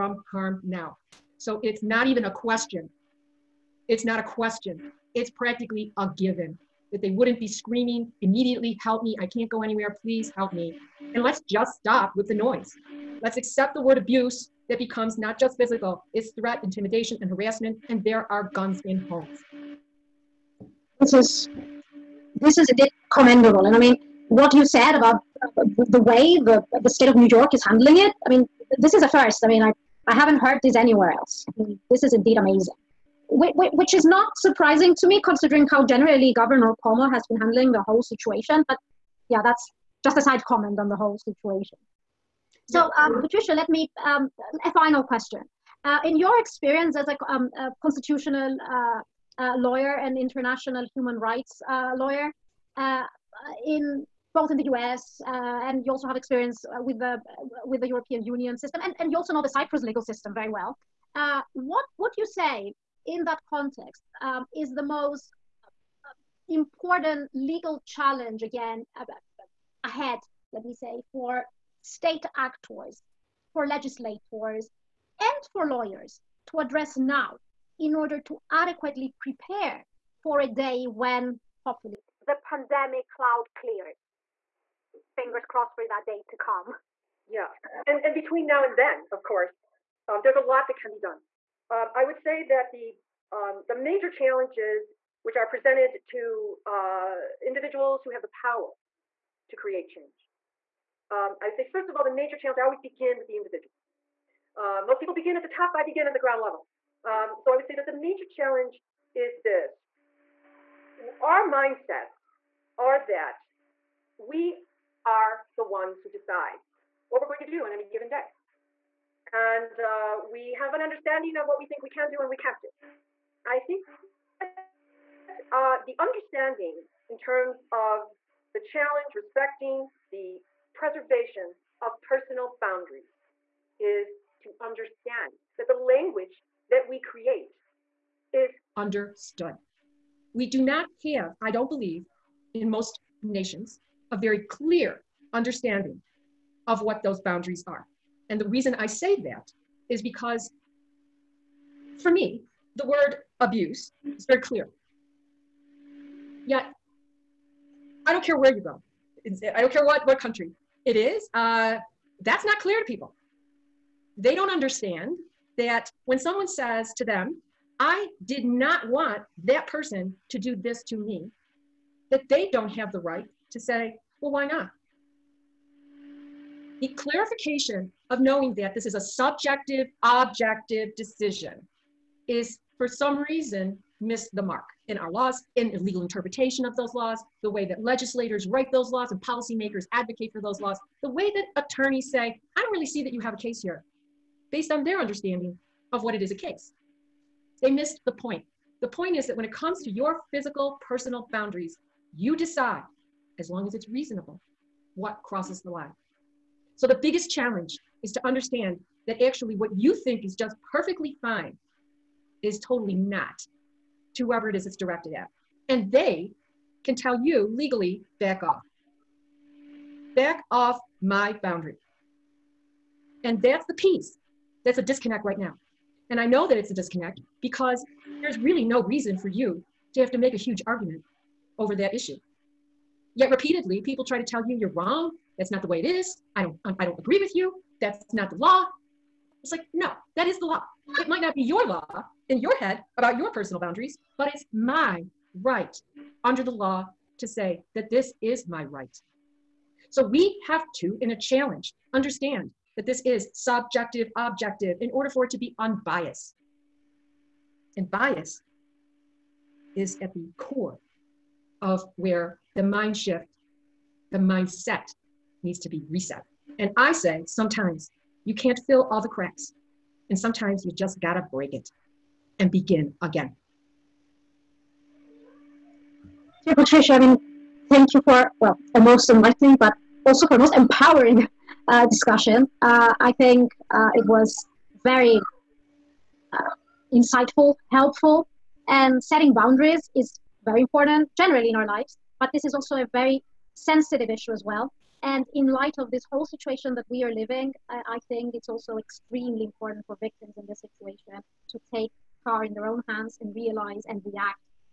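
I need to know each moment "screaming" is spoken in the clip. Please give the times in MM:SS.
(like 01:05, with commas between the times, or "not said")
00:07.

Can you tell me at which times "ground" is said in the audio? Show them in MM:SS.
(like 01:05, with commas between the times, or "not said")
01:46.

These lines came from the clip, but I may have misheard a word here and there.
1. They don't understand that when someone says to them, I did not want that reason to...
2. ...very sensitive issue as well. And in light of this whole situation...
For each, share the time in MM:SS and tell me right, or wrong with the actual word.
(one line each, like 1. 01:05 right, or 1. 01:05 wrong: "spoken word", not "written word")
1. 02:44 wrong: "person", not "reason"
2. 04:52 right.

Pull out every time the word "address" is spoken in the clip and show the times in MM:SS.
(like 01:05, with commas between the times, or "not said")
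01:16.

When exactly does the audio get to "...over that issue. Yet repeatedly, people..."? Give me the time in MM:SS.
03:51.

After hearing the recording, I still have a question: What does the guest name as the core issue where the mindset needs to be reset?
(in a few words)
Bias.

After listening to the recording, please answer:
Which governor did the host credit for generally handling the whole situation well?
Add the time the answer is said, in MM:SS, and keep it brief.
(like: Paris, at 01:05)
Governor Palmer, at 00:36.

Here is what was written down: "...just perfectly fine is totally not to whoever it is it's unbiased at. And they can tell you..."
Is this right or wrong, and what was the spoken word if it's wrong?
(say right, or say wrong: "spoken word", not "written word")
wrong: "directed", not "unbiased".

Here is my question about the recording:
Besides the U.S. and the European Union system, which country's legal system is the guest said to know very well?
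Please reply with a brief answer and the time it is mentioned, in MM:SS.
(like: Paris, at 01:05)
Cyprus, at 00:59.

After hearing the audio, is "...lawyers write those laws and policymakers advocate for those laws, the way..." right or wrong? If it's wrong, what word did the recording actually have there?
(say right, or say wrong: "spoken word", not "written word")
wrong: "legislators", not "lawyers".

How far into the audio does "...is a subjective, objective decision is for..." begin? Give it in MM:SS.
02:58.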